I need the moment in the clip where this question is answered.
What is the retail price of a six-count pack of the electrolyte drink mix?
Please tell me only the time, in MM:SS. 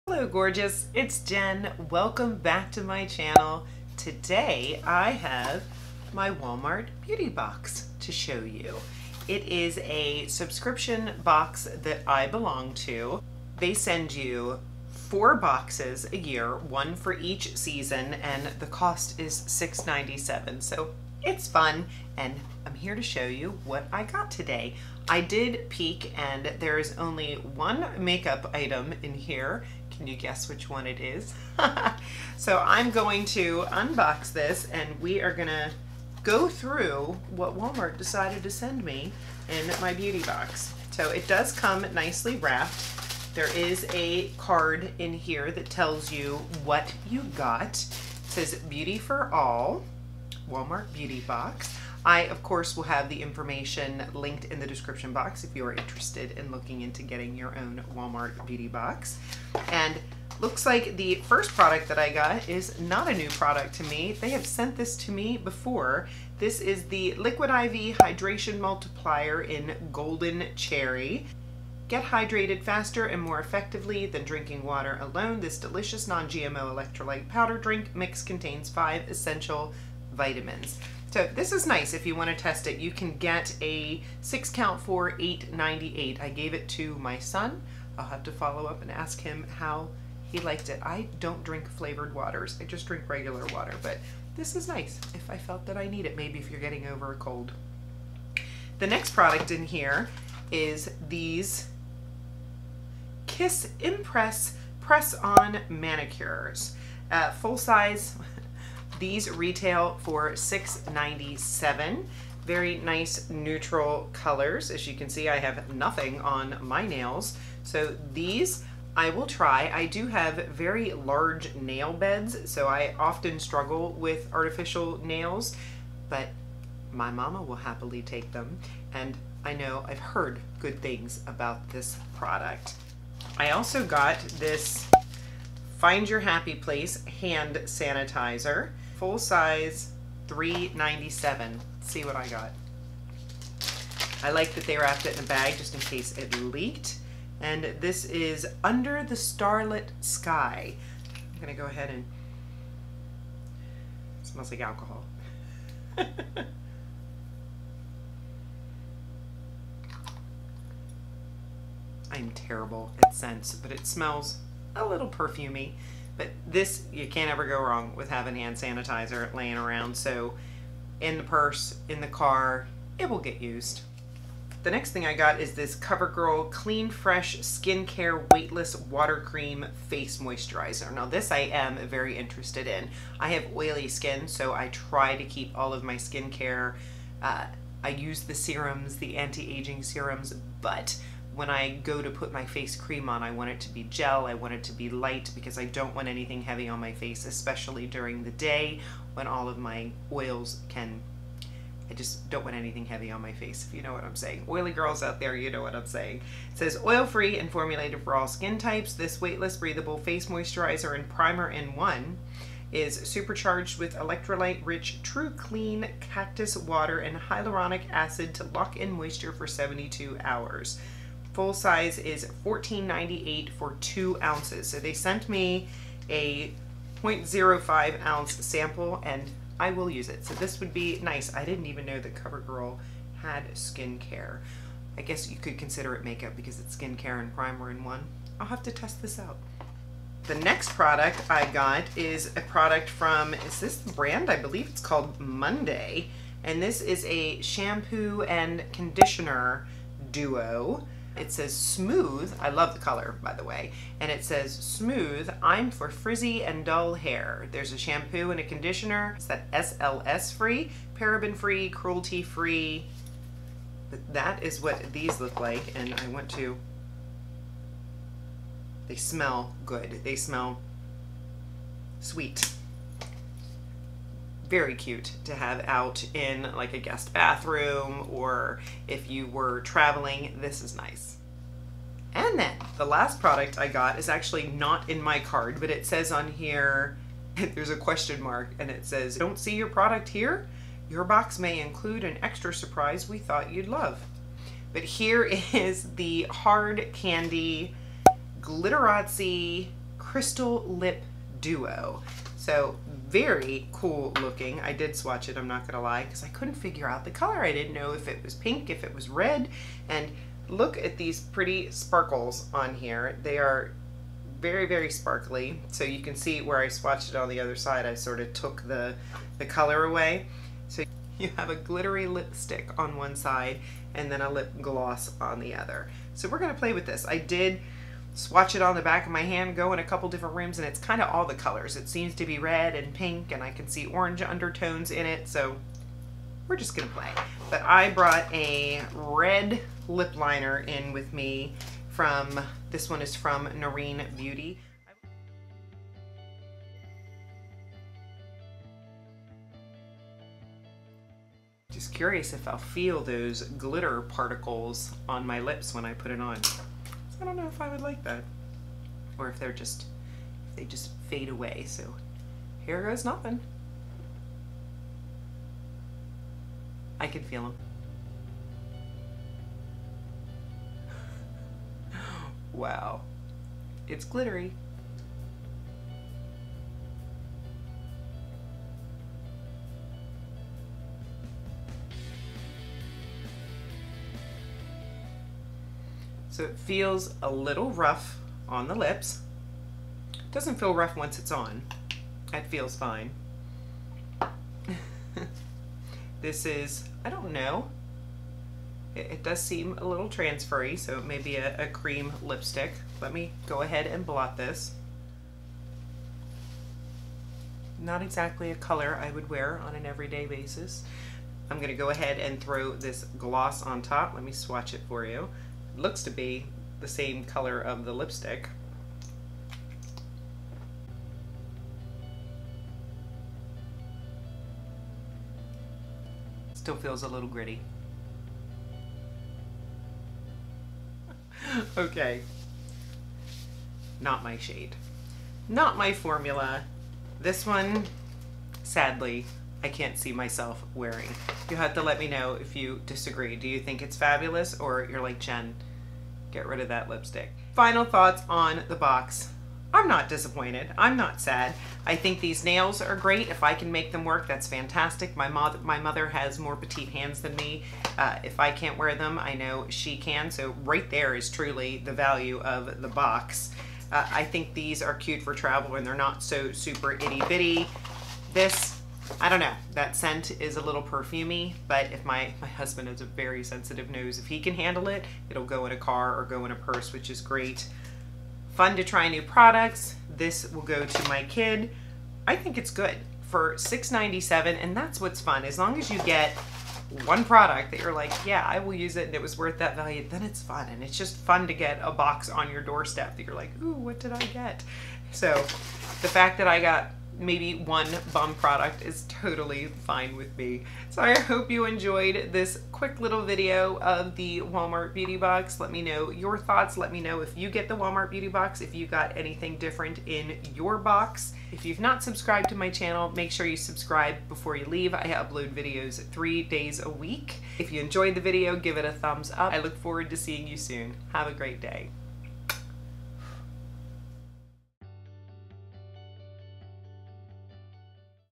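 01:25.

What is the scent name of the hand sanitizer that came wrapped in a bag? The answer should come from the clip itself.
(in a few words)
Under the Starlit Sky.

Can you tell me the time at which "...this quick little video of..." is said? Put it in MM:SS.
08:22.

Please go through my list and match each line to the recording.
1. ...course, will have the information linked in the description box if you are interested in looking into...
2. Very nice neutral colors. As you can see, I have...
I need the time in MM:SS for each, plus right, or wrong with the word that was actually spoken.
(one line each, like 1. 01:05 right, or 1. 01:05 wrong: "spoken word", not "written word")
1. 00:52 right
2. 01:52 right.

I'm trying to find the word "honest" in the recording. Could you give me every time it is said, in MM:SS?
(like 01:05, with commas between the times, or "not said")
not said.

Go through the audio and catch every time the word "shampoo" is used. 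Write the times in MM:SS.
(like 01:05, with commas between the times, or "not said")
04:07, 04:17.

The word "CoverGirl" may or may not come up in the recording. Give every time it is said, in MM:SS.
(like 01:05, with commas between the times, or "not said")
02:55, 03:52.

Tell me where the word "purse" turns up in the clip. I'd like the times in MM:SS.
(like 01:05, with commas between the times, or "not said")
02:51, 07:56.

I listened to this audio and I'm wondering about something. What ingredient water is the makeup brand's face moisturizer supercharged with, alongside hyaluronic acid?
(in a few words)
cactus water.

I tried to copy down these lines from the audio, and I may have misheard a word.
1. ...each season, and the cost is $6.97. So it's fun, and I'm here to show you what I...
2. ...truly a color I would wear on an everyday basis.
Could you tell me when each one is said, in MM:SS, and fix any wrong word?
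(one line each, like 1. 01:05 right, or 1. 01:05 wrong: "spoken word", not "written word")
1. 00:17 right
2. 06:48 wrong: "exactly", not "truly".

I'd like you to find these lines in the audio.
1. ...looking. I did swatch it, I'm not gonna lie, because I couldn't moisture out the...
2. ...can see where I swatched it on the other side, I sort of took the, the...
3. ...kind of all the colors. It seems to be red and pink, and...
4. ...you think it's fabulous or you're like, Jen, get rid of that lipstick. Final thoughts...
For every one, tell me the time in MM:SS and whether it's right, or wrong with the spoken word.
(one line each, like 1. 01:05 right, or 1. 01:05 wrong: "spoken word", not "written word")
1. 05:04 wrong: "figure", not "moisture"
2. 05:15 right
3. 05:30 right
4. 07:23 right.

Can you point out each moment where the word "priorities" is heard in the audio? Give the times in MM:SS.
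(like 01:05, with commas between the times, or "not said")
not said.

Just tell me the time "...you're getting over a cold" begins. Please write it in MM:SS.
01:36.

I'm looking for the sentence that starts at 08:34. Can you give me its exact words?
I upload videos three days a week.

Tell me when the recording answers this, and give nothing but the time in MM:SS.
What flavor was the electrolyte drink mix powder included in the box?
01:09.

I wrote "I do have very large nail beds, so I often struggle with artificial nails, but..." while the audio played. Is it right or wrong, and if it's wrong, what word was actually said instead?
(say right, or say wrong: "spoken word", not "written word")
right.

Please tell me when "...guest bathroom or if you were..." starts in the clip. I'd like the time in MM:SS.
04:36.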